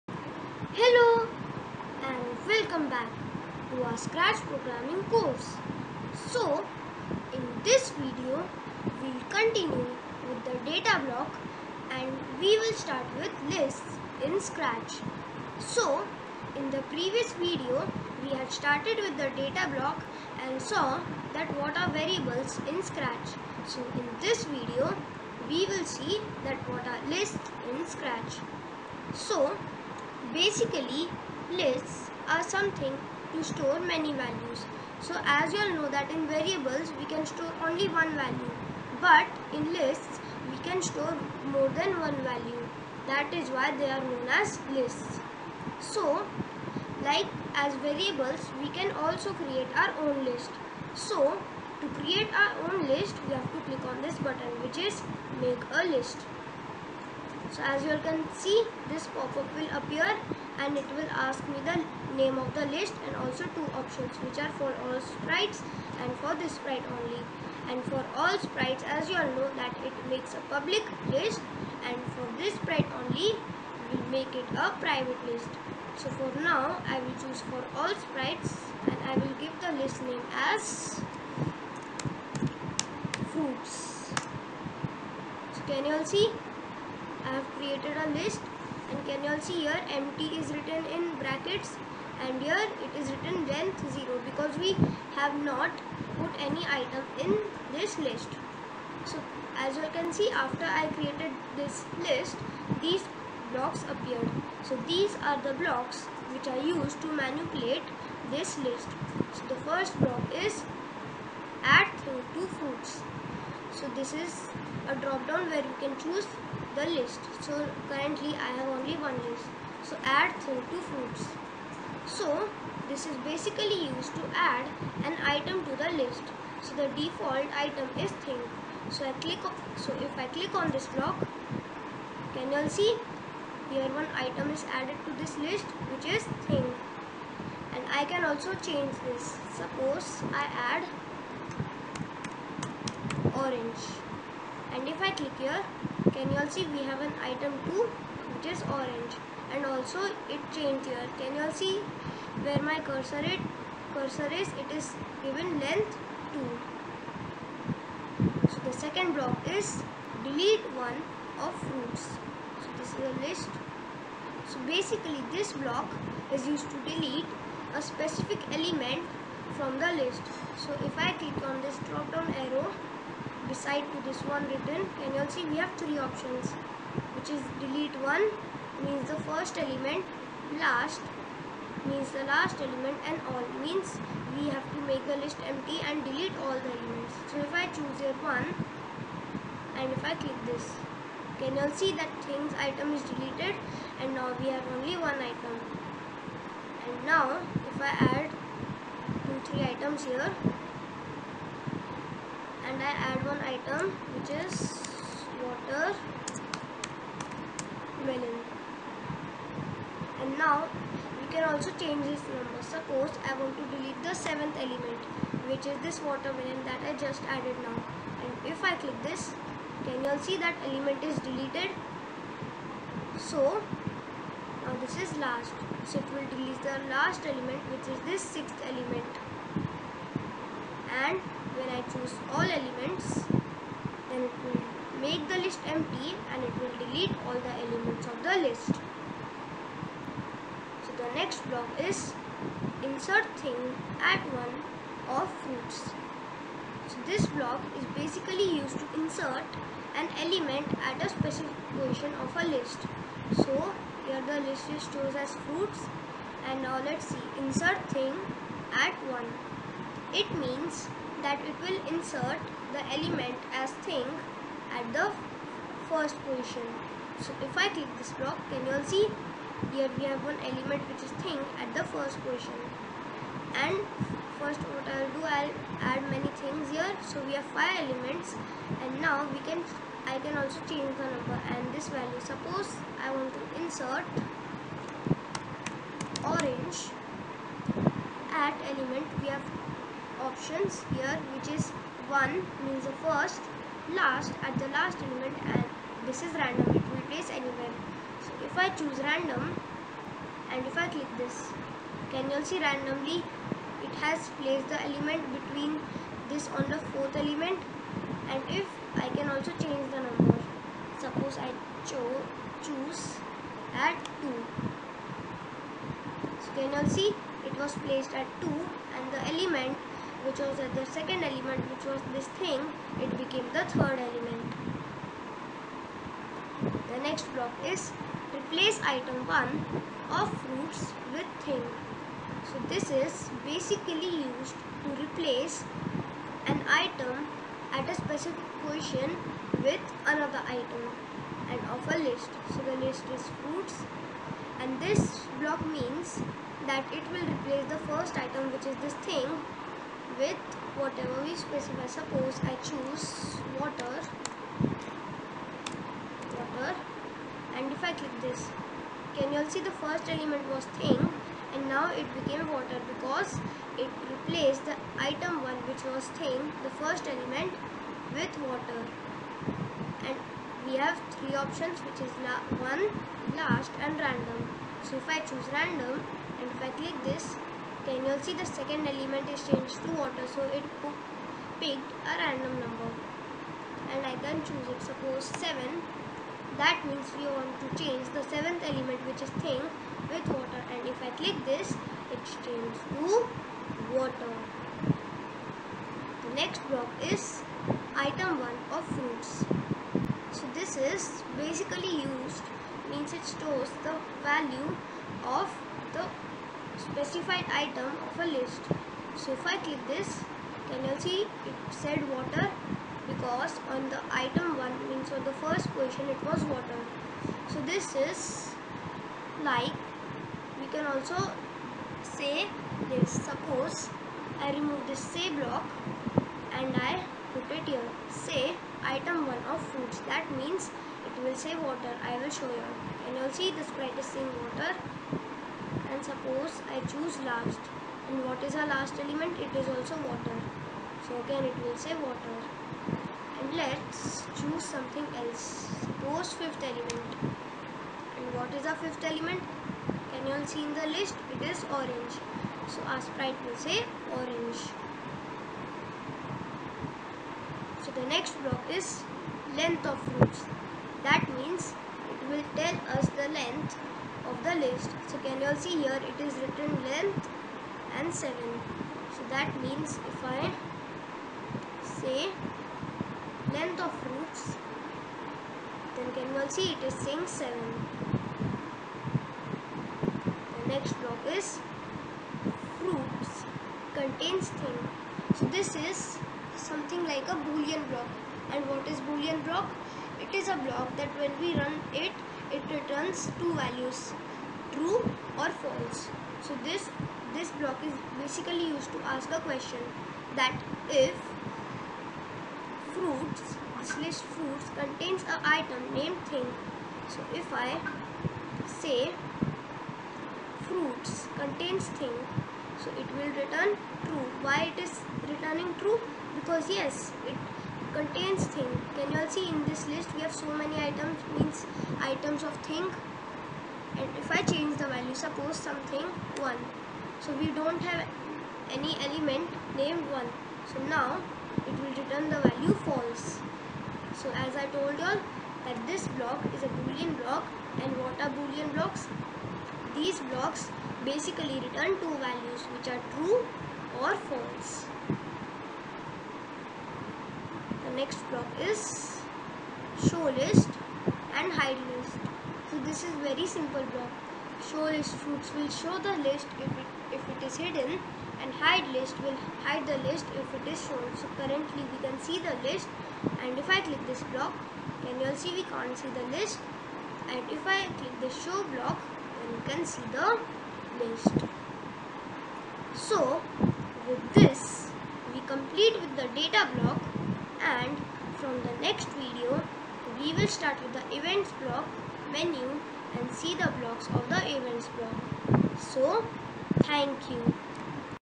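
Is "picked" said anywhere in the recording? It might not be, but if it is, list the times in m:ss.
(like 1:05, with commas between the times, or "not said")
6:21.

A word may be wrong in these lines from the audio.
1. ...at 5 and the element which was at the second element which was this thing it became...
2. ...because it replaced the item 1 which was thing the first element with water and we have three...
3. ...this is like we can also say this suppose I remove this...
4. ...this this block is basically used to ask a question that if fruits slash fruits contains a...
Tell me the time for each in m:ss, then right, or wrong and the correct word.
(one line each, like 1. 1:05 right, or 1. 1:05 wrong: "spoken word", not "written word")
1. 5:18 wrong: "2", not "5"
2. 6:02 right
3. 6:57 right
4. 8:16 right.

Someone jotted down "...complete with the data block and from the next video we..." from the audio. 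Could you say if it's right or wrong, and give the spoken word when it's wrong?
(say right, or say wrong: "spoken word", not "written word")
right.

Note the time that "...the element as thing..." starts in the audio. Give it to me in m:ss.
4:22.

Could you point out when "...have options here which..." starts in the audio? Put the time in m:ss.
4:49.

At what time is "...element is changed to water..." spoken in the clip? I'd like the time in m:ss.
6:18.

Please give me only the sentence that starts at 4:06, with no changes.
So this block is basically used to insert an element at a specific position of a list.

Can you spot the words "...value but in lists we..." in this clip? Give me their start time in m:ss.
0:38.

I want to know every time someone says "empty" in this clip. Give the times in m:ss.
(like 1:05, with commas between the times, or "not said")
1:29, 3:05, 3:55.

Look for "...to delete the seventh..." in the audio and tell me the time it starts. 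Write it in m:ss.
3:33.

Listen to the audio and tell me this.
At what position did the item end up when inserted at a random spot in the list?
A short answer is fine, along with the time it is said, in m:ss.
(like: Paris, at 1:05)
fourth, at 5:06.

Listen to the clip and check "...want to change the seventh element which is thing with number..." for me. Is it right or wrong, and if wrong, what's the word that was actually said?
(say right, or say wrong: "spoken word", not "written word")
wrong: "water", not "number".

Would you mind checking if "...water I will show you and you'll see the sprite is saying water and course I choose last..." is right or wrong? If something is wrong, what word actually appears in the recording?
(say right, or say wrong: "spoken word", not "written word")
wrong: "suppose", not "course".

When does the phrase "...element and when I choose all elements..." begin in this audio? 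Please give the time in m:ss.
3:48.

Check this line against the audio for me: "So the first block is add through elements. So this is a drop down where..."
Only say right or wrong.
wrong.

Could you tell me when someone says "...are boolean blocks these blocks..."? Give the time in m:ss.
8:58.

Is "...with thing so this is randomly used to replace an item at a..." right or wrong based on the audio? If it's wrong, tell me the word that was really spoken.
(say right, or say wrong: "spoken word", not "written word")
wrong: "basically", not "randomly".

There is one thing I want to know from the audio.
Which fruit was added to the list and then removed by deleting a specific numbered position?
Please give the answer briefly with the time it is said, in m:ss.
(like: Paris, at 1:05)
watermelon, at 3:25.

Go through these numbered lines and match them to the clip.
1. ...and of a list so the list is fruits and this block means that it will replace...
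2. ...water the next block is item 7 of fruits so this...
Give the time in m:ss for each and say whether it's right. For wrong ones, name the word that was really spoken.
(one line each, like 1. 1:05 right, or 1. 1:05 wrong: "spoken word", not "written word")
1. 5:41 right
2. 6:33 wrong: "1", not "7".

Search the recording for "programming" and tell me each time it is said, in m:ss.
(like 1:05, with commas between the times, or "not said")
0:04.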